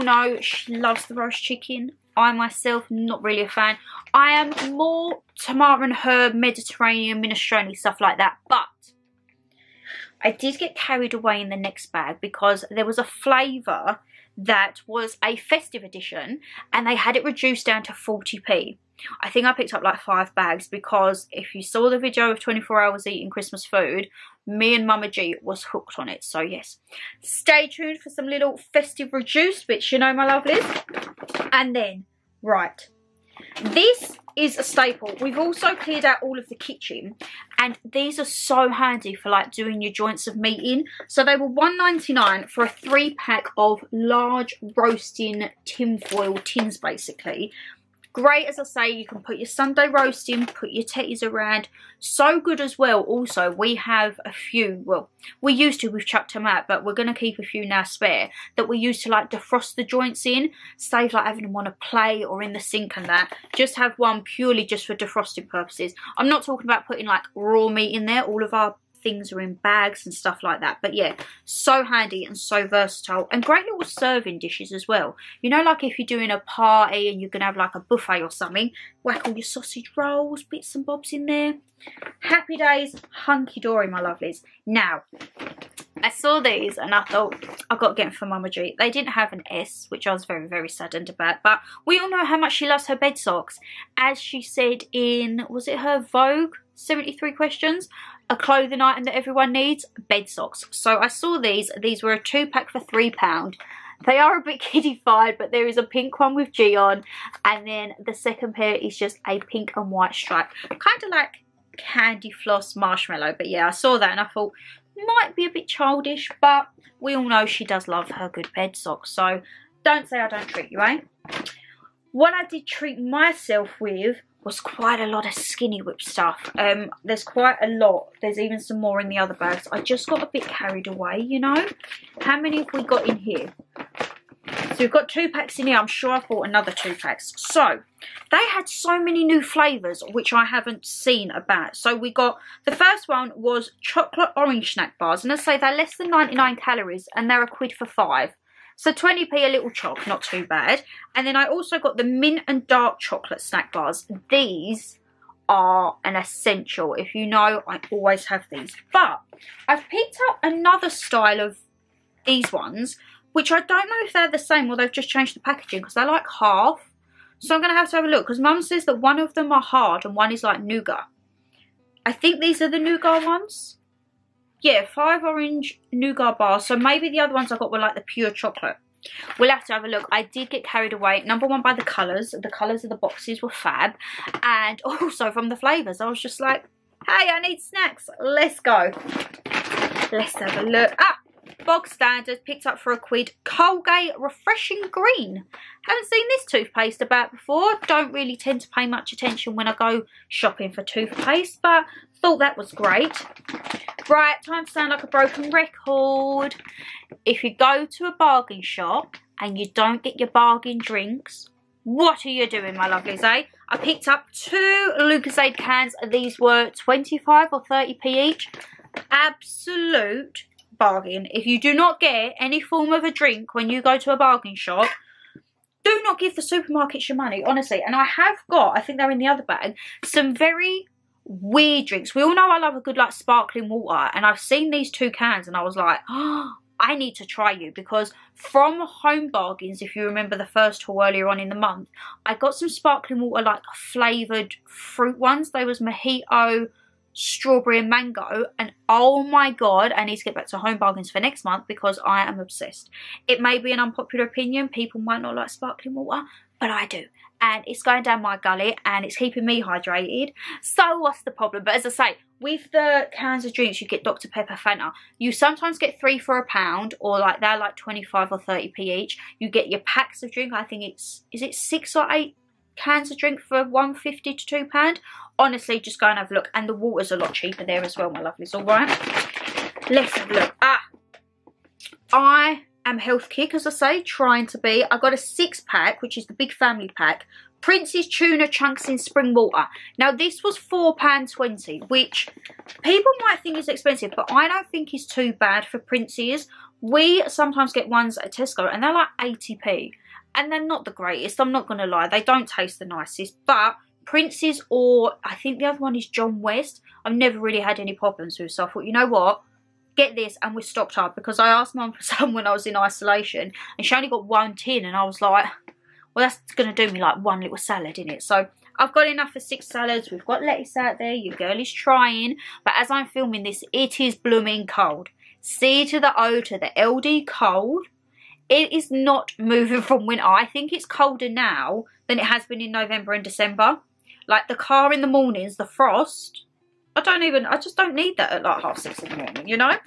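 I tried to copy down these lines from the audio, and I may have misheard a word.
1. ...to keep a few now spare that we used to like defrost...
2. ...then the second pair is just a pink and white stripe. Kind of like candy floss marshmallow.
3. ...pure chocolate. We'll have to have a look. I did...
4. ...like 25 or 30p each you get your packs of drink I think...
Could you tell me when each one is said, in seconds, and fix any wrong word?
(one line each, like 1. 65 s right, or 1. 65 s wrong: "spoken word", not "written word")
1. 57 s right
2. 107 s right
3. 178 s right
4. 267 s right.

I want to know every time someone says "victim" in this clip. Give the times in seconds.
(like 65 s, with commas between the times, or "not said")
not said.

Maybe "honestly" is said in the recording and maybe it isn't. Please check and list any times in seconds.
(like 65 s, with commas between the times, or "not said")
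227 s, 275 s.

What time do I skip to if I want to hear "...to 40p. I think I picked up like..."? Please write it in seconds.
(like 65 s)
17 s.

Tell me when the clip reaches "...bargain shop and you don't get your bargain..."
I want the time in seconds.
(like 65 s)
208 s.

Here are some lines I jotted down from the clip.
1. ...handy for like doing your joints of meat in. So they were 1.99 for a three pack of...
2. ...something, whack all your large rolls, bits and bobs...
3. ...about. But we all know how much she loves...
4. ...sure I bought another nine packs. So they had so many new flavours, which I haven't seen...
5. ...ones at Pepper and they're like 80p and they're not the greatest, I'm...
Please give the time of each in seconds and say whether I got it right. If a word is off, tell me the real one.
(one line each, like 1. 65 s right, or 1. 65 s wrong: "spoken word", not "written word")
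1. 38 s right
2. 78 s wrong: "sausage", not "large"
3. 91 s right
4. 135 s wrong: "two", not "nine"
5. 297 s wrong: "Tesco", not "Pepper".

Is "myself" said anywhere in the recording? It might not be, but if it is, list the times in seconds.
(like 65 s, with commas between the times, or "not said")
2 s, 122 s.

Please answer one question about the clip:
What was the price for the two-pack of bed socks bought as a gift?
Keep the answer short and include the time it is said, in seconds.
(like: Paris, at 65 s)
£3, at 102 s.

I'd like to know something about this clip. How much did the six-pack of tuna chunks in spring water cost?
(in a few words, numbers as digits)
£4.20.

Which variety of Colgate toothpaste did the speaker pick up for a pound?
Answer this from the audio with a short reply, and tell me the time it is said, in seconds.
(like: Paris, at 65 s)
Refreshing Green, at 194 s.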